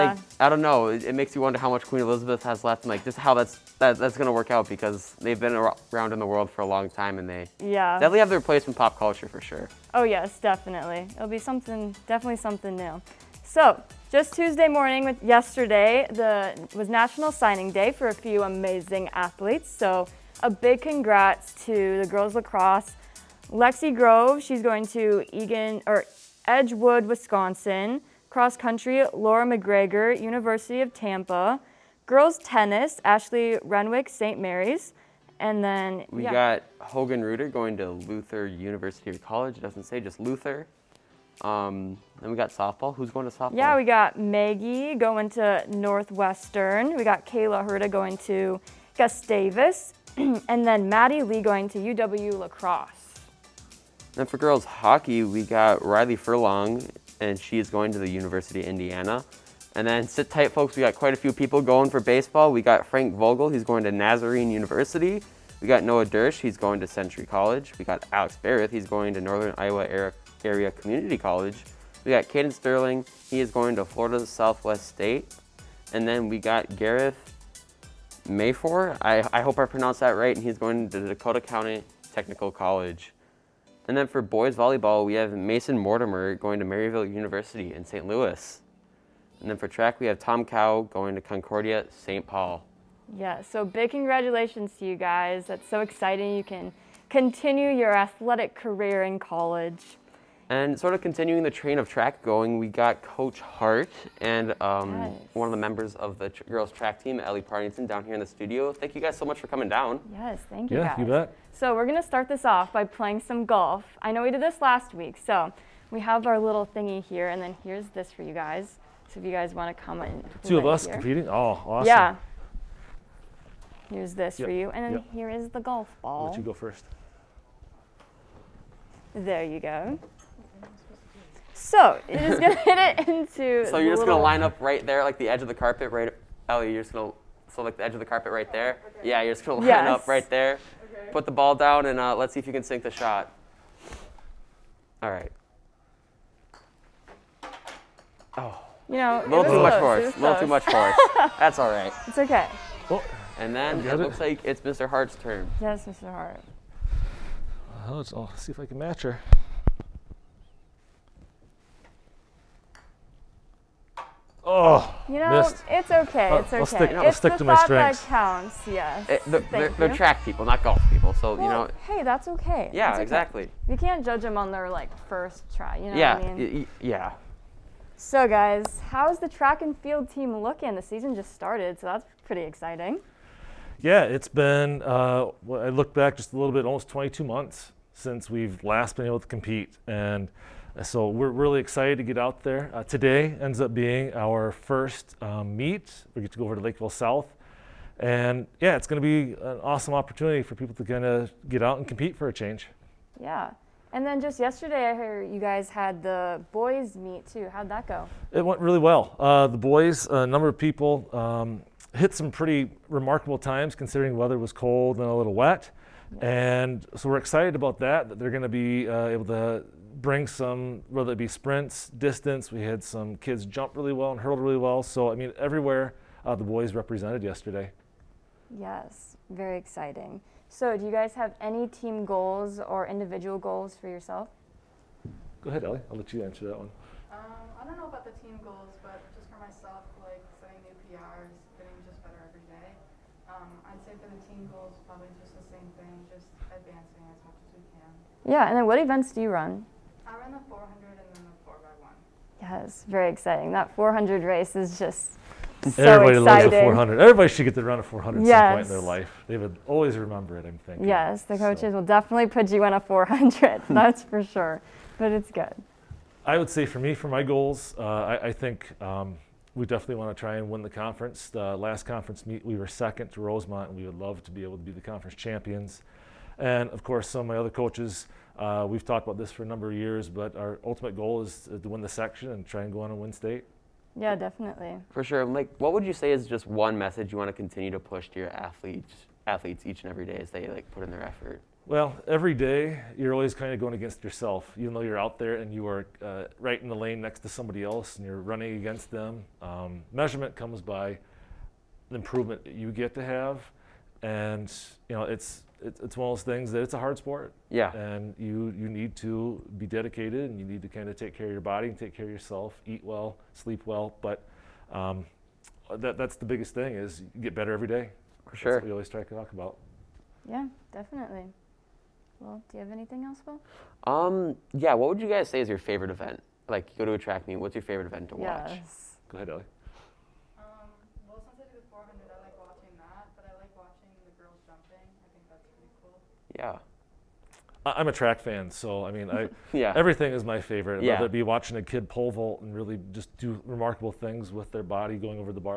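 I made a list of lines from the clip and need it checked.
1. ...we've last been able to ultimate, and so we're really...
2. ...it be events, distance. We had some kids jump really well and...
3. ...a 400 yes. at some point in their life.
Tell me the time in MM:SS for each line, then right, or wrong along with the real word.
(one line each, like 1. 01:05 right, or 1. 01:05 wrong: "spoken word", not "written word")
1. 03:08 wrong: "compete", not "ultimate"
2. 03:41 wrong: "sprints", not "events"
3. 04:17 right.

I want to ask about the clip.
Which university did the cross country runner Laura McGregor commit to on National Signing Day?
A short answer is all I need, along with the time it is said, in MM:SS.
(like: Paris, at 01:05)
University of Tampa, at 00:30.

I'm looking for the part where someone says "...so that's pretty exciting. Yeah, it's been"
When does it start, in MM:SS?
03:01.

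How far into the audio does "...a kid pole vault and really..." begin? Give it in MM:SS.
05:41.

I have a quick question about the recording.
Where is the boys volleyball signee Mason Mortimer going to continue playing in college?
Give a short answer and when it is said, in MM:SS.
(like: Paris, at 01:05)
Maryville University, at 01:26.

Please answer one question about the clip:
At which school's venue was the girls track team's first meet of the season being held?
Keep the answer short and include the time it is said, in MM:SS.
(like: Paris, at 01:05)
Lakeville South, at 03:16.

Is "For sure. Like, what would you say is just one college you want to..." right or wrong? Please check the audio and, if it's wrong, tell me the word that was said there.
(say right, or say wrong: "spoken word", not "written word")
wrong: "message", not "college".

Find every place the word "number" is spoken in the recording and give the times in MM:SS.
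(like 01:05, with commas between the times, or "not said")
03:30, 04:39.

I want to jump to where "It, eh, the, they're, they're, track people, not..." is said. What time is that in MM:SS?
02:49.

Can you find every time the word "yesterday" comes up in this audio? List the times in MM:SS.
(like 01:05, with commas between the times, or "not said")
00:15, 03:24, 03:47.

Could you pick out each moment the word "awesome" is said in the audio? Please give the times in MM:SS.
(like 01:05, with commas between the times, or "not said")
02:01, 03:19.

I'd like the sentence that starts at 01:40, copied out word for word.
And sort of continuing the train of track going, we got Coach Hart and um, yes.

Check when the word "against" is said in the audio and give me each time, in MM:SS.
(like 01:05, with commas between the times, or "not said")
04:53, 04:58.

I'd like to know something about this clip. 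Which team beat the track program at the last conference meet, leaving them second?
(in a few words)
Rosemount.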